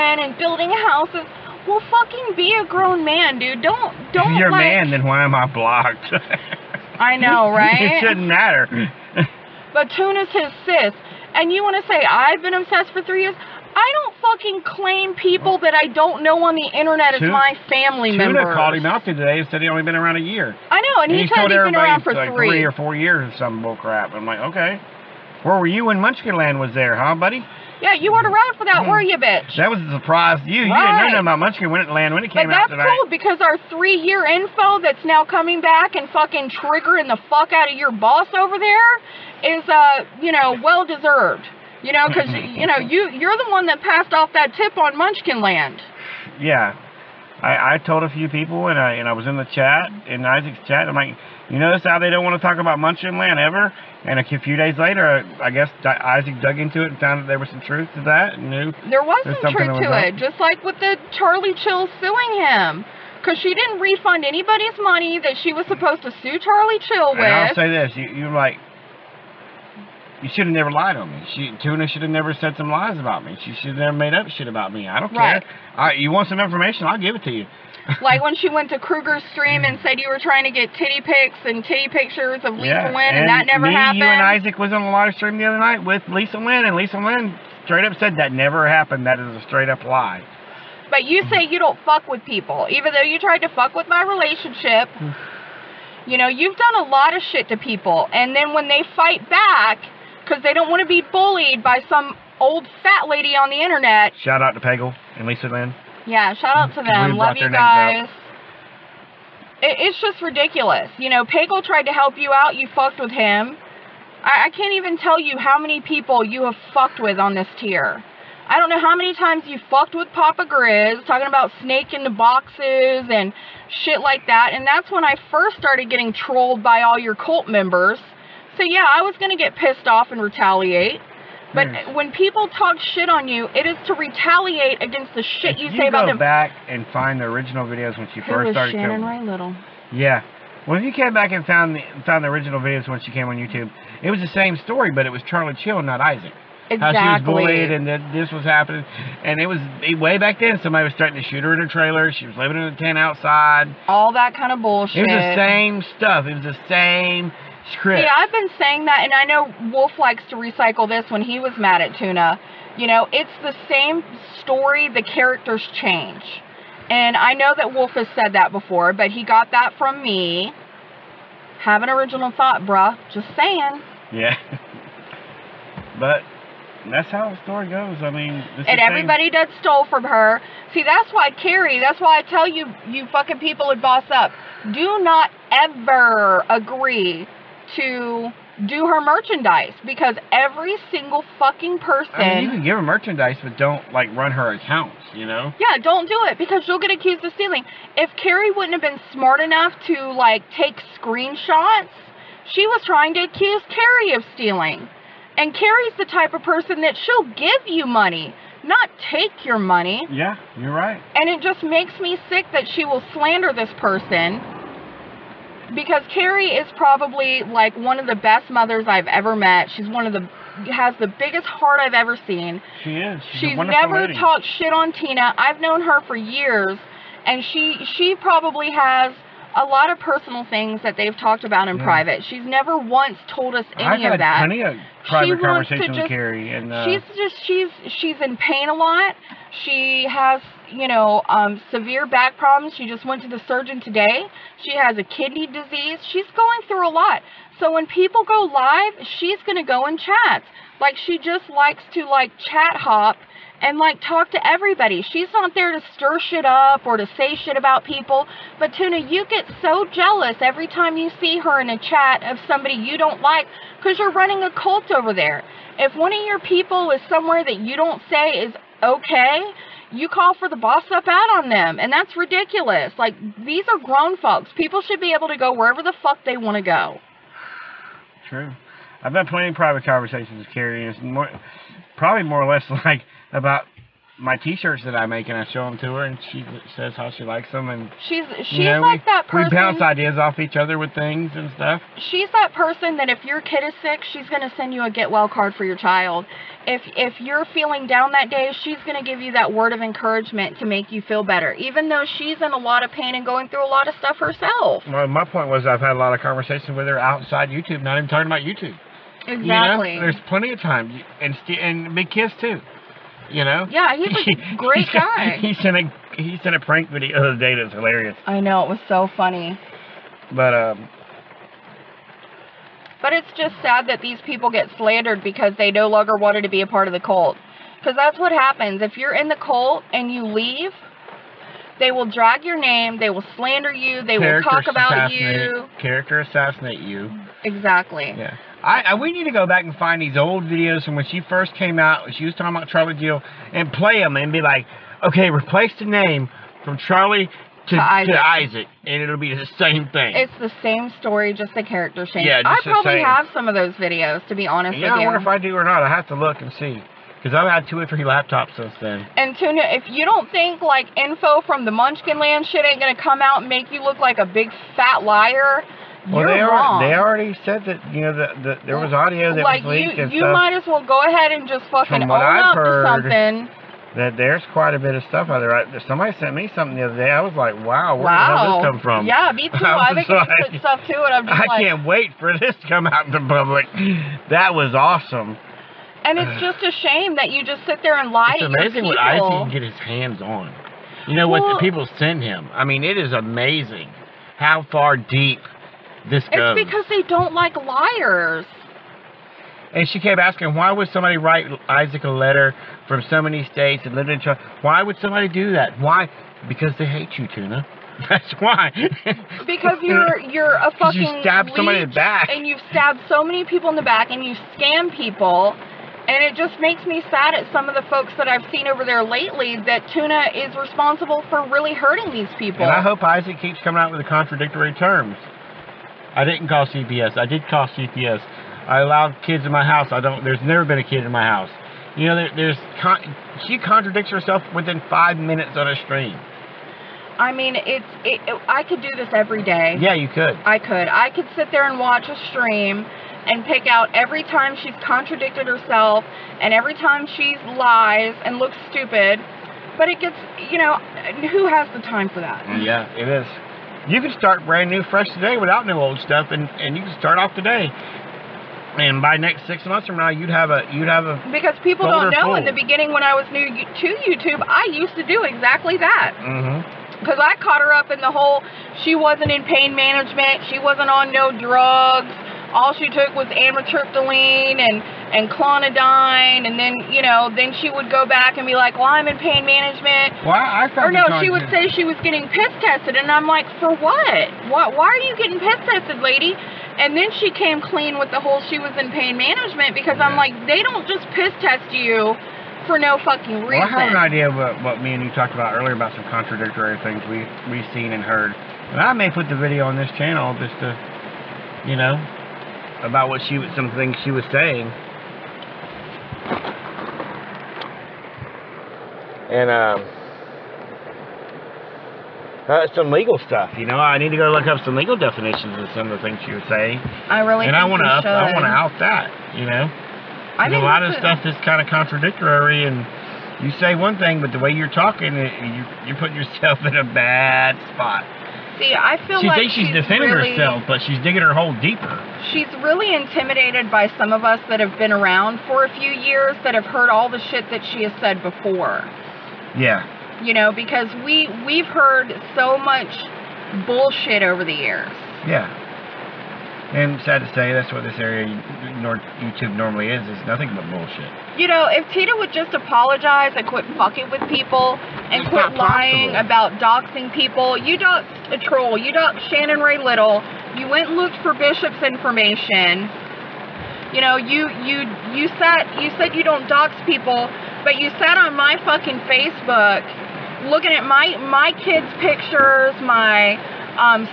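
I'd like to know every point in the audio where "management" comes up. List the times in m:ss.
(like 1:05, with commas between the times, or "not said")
7:49, 7:59, 8:09.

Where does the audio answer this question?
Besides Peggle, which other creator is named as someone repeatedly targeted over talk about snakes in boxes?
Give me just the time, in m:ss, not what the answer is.
2:00.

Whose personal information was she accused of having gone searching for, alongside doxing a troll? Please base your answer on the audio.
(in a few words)
Bishop.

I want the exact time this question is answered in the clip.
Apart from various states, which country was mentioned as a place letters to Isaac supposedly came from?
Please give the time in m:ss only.
6:44.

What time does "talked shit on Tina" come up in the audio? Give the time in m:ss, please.
3:44.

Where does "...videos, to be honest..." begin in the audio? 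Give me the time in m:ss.
5:53.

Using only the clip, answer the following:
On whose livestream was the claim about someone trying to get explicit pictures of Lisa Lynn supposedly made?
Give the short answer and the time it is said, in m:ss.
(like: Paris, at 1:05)
Kruger, at 1:18.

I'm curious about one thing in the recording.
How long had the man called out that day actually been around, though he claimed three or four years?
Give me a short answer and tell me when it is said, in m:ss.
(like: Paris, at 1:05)
1 year, at 0:20.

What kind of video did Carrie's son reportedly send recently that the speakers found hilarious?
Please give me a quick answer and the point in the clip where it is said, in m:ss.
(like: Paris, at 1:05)
A prank video, at 5:16.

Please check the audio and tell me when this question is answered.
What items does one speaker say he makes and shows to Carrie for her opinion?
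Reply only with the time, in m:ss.
4:44.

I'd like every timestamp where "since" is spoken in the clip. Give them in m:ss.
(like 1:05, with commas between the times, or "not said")
5:58.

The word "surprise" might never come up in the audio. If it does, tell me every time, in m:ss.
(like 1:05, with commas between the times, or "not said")
0:30.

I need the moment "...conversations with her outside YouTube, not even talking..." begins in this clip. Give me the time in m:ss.
5:06.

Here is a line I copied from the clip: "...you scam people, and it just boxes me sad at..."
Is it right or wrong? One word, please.
wrong.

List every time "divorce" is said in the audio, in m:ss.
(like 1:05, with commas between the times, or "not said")
not said.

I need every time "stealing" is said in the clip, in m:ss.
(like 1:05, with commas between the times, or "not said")
3:17, 3:24.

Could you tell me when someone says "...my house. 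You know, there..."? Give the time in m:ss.
7:11.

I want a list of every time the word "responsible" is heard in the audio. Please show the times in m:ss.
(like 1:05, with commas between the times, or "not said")
7:00.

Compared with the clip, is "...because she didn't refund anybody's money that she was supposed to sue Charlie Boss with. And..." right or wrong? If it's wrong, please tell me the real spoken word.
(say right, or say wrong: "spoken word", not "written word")
wrong: "Chill", not "Boss".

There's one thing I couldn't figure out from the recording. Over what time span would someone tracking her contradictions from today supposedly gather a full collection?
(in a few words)
6 months.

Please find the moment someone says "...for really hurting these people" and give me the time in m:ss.
7:01.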